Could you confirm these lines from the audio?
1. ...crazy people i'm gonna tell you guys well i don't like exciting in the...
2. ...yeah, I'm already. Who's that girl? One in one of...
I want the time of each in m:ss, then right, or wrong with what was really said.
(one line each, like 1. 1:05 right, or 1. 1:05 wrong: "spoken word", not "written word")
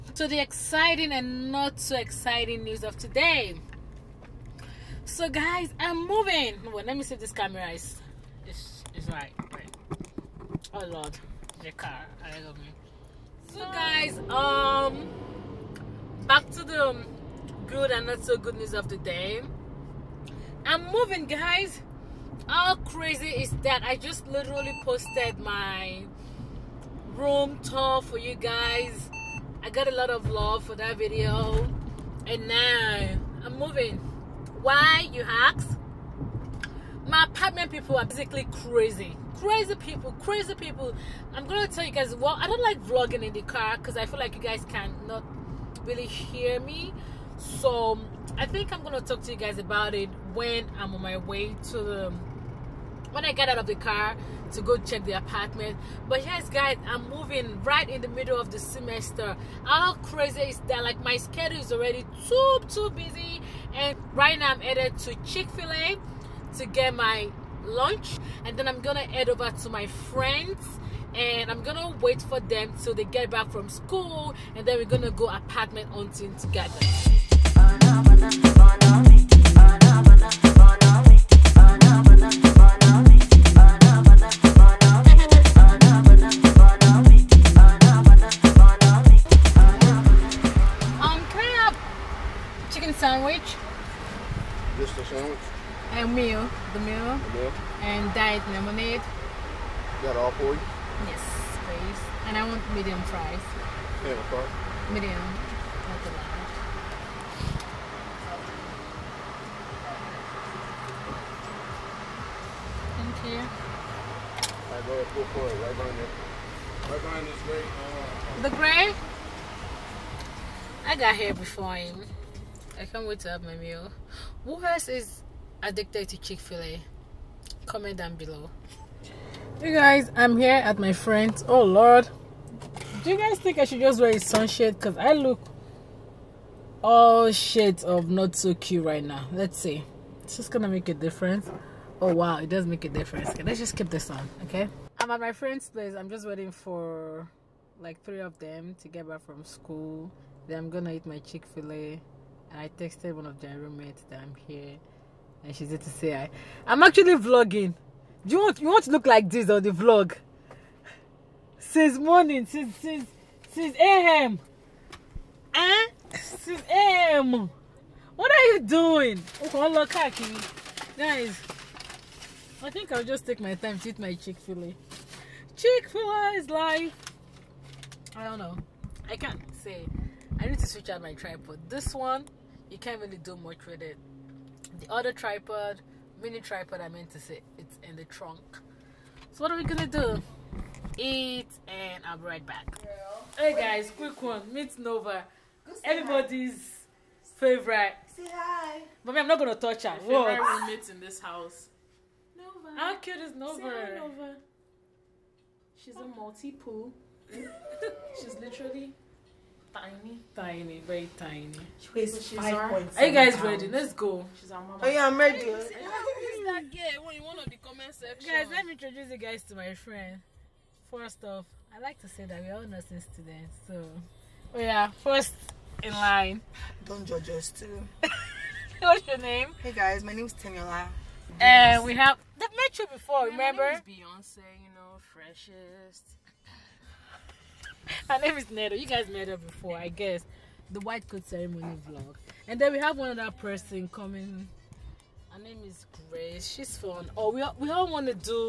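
1. 0:40 wrong: "vlogging", not "exciting"
2. 3:34 wrong: "ready", not "already".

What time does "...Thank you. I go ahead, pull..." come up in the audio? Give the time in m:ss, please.
1:52.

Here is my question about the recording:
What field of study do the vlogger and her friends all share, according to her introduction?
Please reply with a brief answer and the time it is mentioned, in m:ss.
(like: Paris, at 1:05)
Nursing, at 3:42.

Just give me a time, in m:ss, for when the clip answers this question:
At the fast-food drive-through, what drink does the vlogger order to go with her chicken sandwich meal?
1:38.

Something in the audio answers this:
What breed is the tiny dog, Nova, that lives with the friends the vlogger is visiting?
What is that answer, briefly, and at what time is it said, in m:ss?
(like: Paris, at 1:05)
Maltipoo, at 3:26.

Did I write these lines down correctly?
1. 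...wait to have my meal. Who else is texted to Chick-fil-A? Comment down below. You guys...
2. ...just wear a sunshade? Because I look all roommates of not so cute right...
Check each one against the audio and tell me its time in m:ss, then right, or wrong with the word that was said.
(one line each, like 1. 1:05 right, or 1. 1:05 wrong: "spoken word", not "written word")
1. 2:03 wrong: "addicted", not "texted"
2. 2:13 wrong: "shades", not "roommates".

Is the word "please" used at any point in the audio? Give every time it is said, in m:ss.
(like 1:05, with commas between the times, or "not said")
1:41.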